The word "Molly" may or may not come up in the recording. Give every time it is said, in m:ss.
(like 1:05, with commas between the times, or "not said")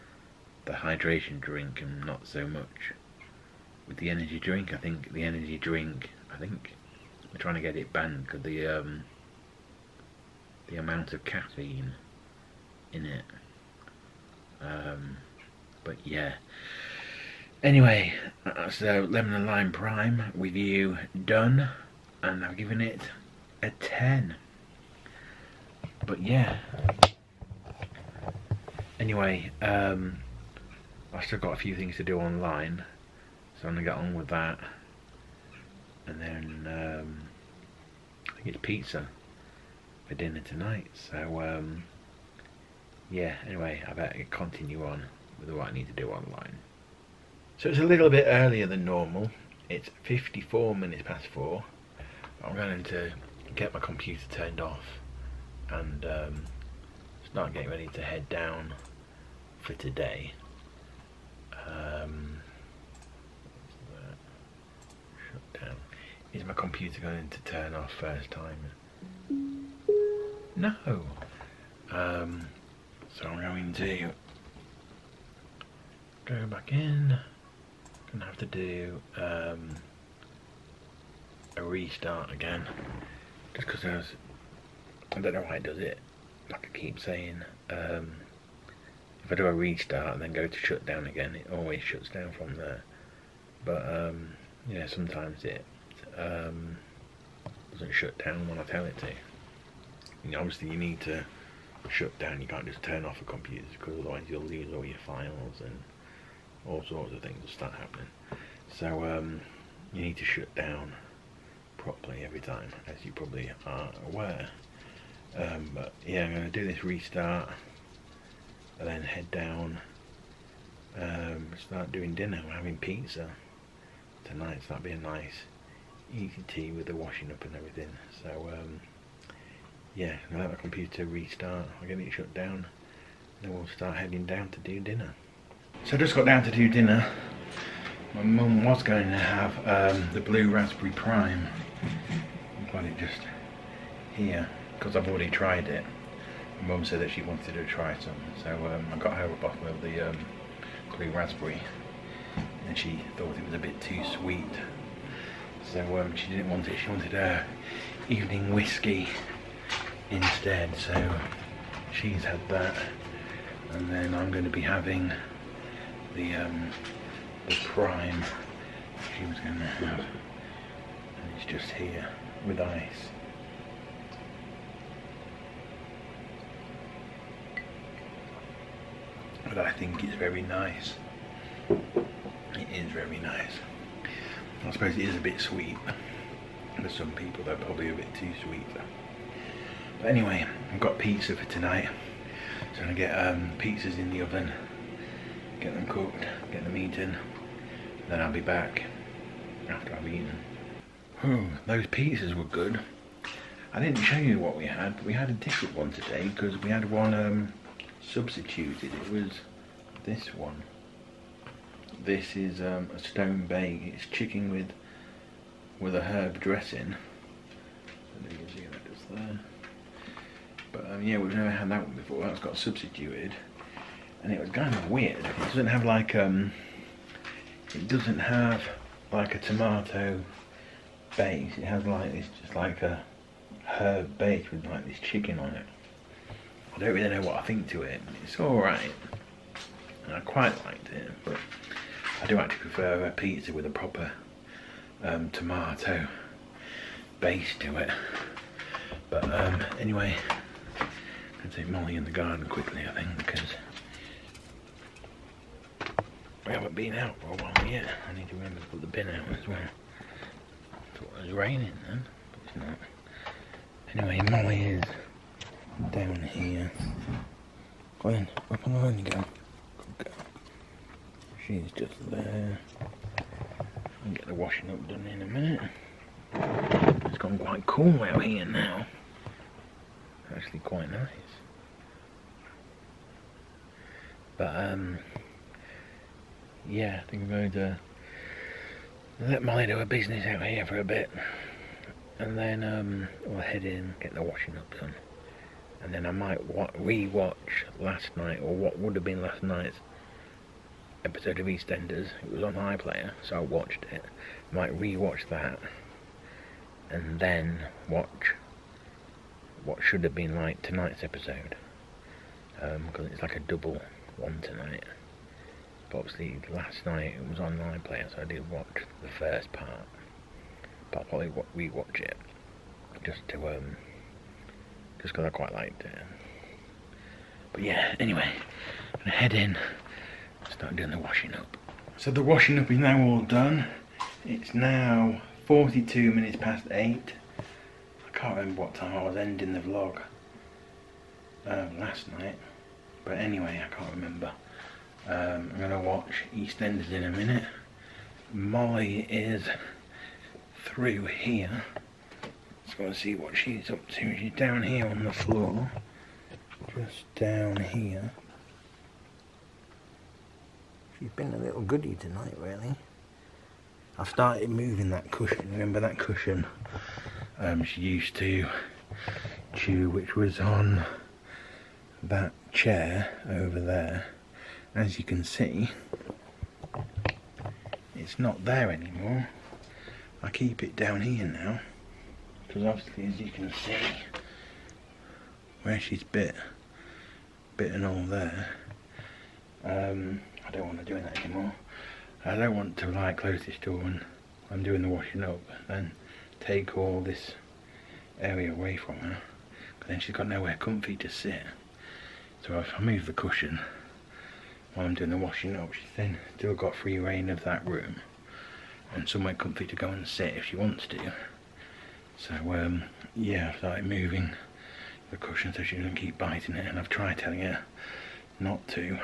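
4:11, 4:24, 4:49, 5:48.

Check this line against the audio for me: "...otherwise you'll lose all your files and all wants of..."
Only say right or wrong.
wrong.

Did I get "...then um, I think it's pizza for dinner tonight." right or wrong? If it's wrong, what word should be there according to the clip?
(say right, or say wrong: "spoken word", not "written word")
right.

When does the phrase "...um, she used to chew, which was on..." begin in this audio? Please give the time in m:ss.
6:07.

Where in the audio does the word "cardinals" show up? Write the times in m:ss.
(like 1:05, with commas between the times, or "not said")
not said.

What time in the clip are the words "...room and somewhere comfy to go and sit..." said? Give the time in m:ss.
6:47.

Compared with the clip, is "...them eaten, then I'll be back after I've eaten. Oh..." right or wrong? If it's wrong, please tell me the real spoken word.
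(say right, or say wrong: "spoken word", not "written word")
right.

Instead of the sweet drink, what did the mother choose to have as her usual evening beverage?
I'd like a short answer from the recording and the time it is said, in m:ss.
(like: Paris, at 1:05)
Whiskey, at 2:38.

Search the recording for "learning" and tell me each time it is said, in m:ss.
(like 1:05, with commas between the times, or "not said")
not said.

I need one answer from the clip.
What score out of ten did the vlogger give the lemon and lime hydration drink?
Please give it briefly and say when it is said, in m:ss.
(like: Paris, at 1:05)
10, at 0:23.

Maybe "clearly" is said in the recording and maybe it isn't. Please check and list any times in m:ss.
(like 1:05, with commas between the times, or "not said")
not said.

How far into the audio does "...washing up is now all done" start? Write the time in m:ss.
5:32.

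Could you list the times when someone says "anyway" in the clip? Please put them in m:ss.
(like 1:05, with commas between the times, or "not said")
0:17, 0:28, 0:43, 3:10, 4:09, 4:24, 5:27, 5:43.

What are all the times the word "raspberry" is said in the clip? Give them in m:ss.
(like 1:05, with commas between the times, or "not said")
2:20, 2:31.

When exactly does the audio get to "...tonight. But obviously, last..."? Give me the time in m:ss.
5:14.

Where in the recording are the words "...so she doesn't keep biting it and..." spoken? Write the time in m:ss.
6:55.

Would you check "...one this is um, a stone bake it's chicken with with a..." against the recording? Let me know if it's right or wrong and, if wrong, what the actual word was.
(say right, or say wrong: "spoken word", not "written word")
right.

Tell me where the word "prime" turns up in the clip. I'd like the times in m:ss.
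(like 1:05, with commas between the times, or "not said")
0:19, 2:20, 2:47.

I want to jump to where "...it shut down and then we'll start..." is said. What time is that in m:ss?
2:11.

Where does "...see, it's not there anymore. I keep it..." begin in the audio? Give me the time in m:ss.
6:15.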